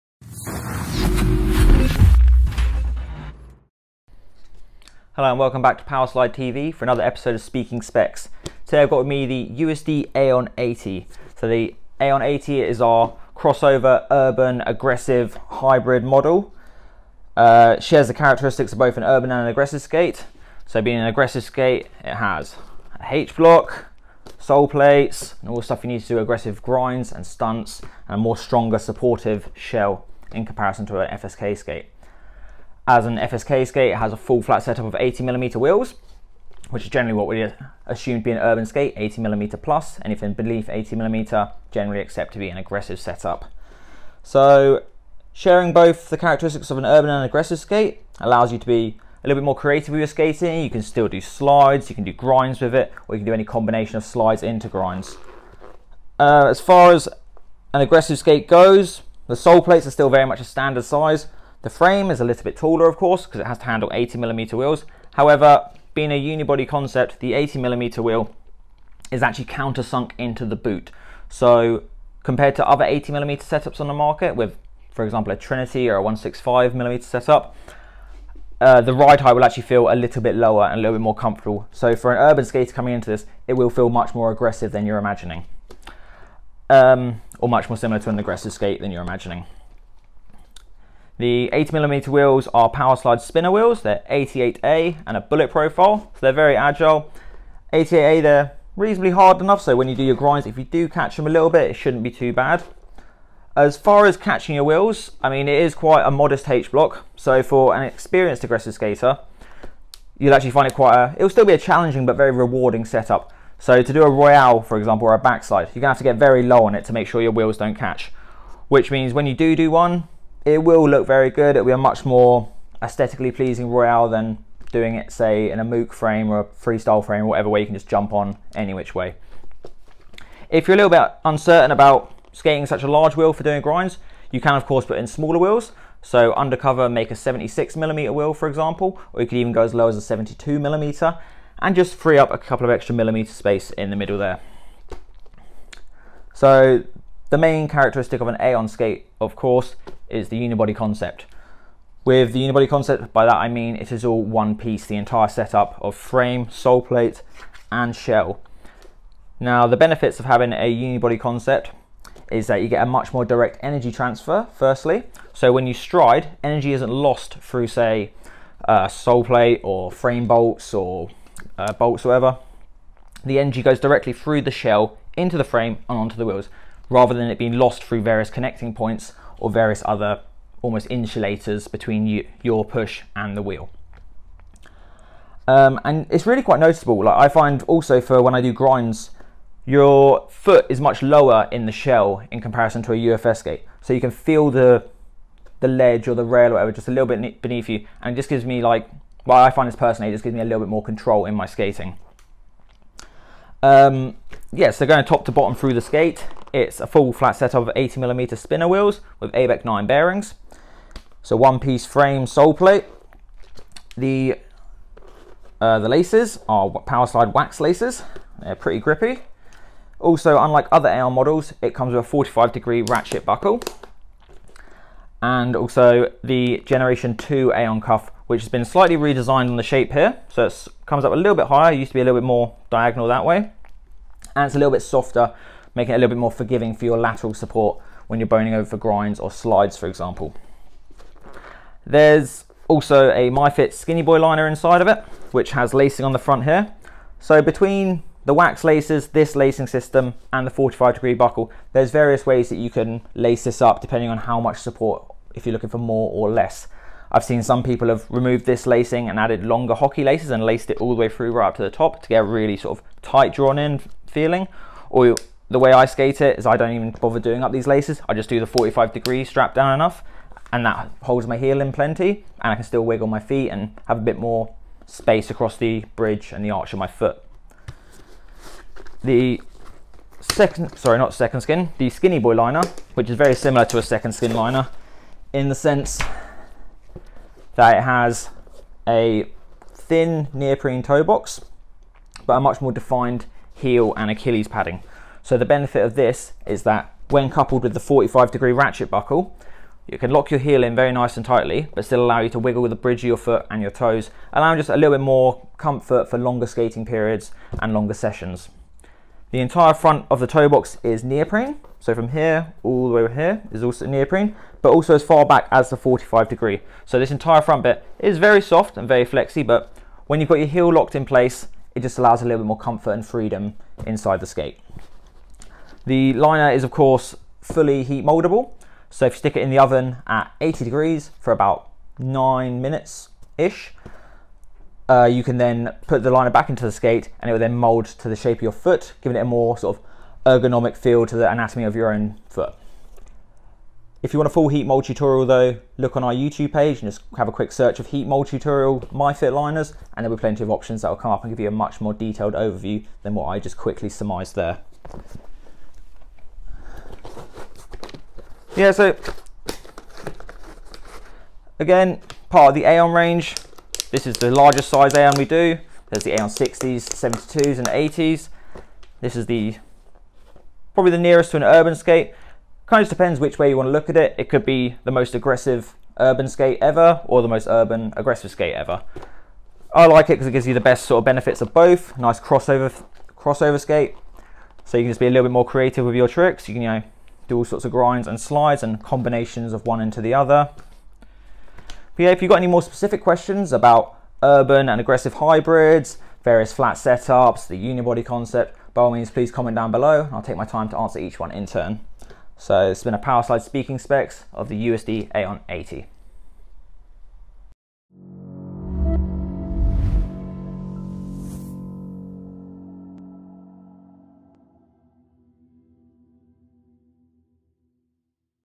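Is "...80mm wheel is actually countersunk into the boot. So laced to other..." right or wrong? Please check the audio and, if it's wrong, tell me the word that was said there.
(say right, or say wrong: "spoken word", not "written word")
wrong: "compared", not "laced".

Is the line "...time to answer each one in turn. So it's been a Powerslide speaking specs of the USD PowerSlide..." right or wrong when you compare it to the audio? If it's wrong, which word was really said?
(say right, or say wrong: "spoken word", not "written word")
wrong: "Aeon", not "PowerSlide".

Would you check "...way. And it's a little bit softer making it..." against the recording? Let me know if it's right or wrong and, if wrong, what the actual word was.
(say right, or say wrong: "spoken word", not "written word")
right.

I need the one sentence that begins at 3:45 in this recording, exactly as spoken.
And also the Generation 2 Aeon cuff, which has been slightly redesigned on the shape here.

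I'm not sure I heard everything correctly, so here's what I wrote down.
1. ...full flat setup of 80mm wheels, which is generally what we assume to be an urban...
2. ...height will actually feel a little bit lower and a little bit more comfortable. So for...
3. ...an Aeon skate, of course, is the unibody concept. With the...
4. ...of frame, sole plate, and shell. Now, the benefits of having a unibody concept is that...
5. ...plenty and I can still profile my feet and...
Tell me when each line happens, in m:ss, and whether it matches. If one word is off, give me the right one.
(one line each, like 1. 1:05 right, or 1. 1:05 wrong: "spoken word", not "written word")
1. 0:34 right
2. 1:19 right
3. 2:28 right
4. 2:35 right
5. 4:31 wrong: "wiggle", not "profile".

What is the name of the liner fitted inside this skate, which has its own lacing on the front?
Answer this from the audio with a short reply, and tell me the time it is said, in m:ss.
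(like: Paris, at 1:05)
MyFit Skinny Boy, at 4:03.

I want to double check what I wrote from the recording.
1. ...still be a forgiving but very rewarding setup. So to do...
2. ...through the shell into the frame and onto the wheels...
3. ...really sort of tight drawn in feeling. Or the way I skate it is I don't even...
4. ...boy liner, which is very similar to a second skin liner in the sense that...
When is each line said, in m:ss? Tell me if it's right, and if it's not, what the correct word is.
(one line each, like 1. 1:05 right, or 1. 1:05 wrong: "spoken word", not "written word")
1. 1:51 wrong: "challenging", not "forgiving"
2. 2:54 right
3. 4:22 right
4. 4:42 right.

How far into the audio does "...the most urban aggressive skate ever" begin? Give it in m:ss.
6:17.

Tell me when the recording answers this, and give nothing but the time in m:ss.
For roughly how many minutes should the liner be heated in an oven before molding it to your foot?
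5:31.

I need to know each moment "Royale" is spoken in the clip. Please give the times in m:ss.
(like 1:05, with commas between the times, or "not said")
1:54, 2:03.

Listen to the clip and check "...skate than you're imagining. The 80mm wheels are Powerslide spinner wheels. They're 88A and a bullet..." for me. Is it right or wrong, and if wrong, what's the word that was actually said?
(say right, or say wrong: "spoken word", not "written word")
right.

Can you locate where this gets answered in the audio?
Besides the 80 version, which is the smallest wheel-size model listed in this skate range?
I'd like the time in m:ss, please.
6:06.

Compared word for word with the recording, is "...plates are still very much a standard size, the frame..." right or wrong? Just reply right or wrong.
right.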